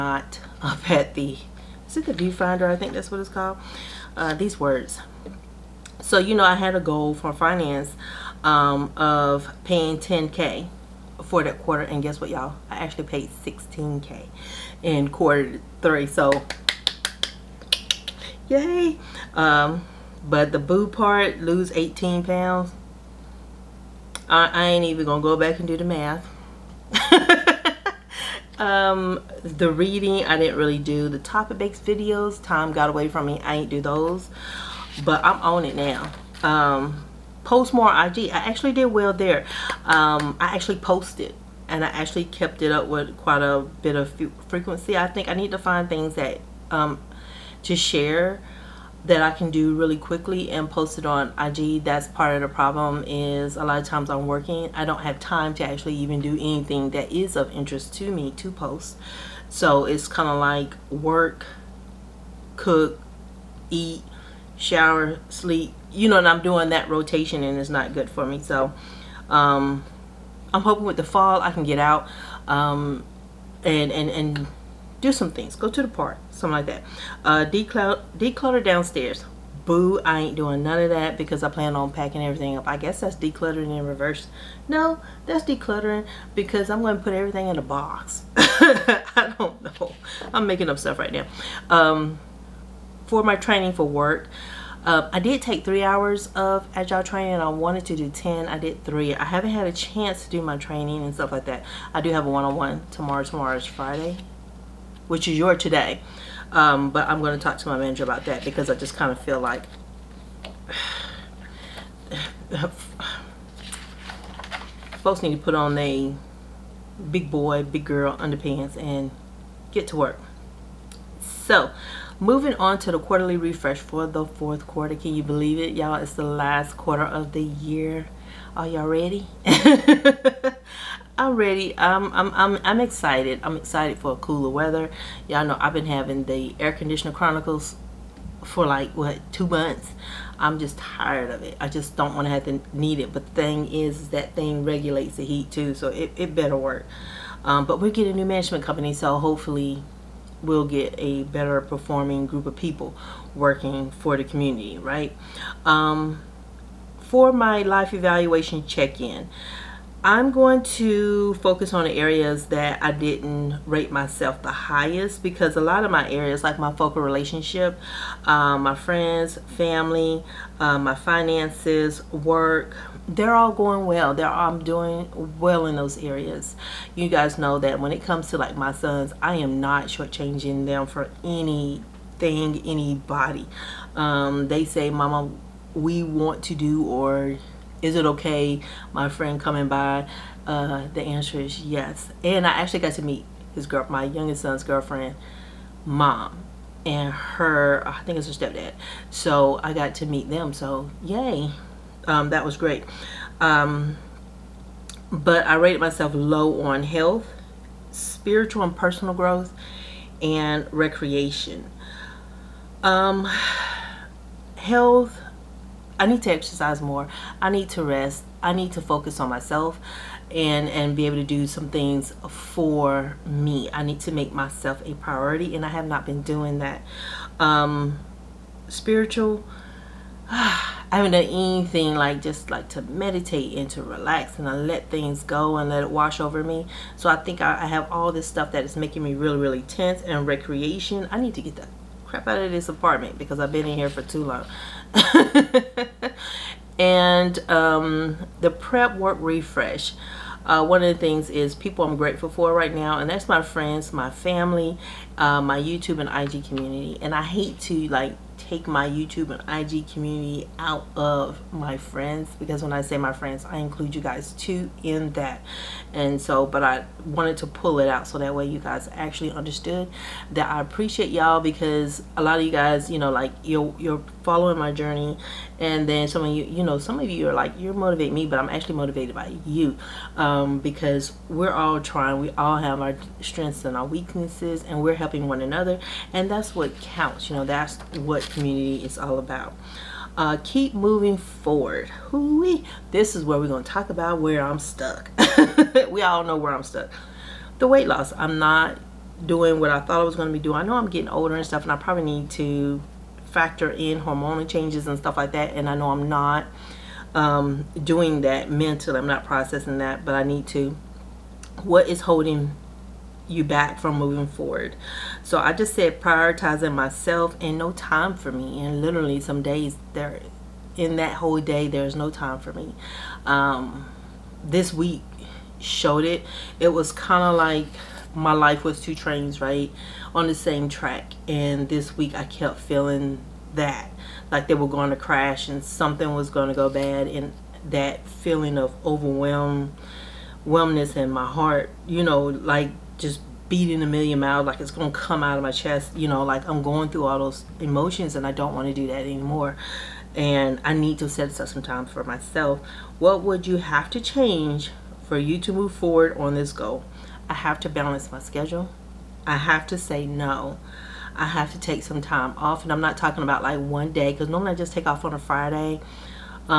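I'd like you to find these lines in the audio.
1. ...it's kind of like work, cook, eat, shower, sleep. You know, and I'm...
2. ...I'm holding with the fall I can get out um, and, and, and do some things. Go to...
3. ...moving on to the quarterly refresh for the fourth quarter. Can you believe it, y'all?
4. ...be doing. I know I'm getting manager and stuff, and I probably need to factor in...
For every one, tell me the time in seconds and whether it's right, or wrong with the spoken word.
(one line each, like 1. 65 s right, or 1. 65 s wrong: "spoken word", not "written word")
1. 59 s right
2. 70 s wrong: "hoping", not "holding"
3. 122 s right
4. 300 s wrong: "older", not "manager".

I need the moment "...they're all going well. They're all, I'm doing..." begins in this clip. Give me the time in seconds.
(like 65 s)
173 s.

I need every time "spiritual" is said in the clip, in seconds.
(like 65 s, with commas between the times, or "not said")
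207 s, 228 s.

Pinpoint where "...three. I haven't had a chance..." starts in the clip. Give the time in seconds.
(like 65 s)
98 s.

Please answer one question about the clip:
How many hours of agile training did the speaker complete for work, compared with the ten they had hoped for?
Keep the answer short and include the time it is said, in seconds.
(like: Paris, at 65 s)
3, at 95 s.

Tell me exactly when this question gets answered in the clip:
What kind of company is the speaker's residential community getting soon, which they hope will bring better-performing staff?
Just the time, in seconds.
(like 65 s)
148 s.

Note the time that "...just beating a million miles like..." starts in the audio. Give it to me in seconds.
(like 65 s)
343 s.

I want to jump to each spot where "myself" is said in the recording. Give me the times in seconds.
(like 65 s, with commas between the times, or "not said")
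163 s, 205 s, 219 s, 224 s, 316 s, 352 s.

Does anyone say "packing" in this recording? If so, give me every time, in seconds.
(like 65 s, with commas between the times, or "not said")
81 s.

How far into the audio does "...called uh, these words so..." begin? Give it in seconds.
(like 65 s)
3 s.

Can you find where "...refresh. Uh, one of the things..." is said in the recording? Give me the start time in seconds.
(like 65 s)
249 s.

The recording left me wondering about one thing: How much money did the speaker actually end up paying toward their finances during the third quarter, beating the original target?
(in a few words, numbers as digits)
16k.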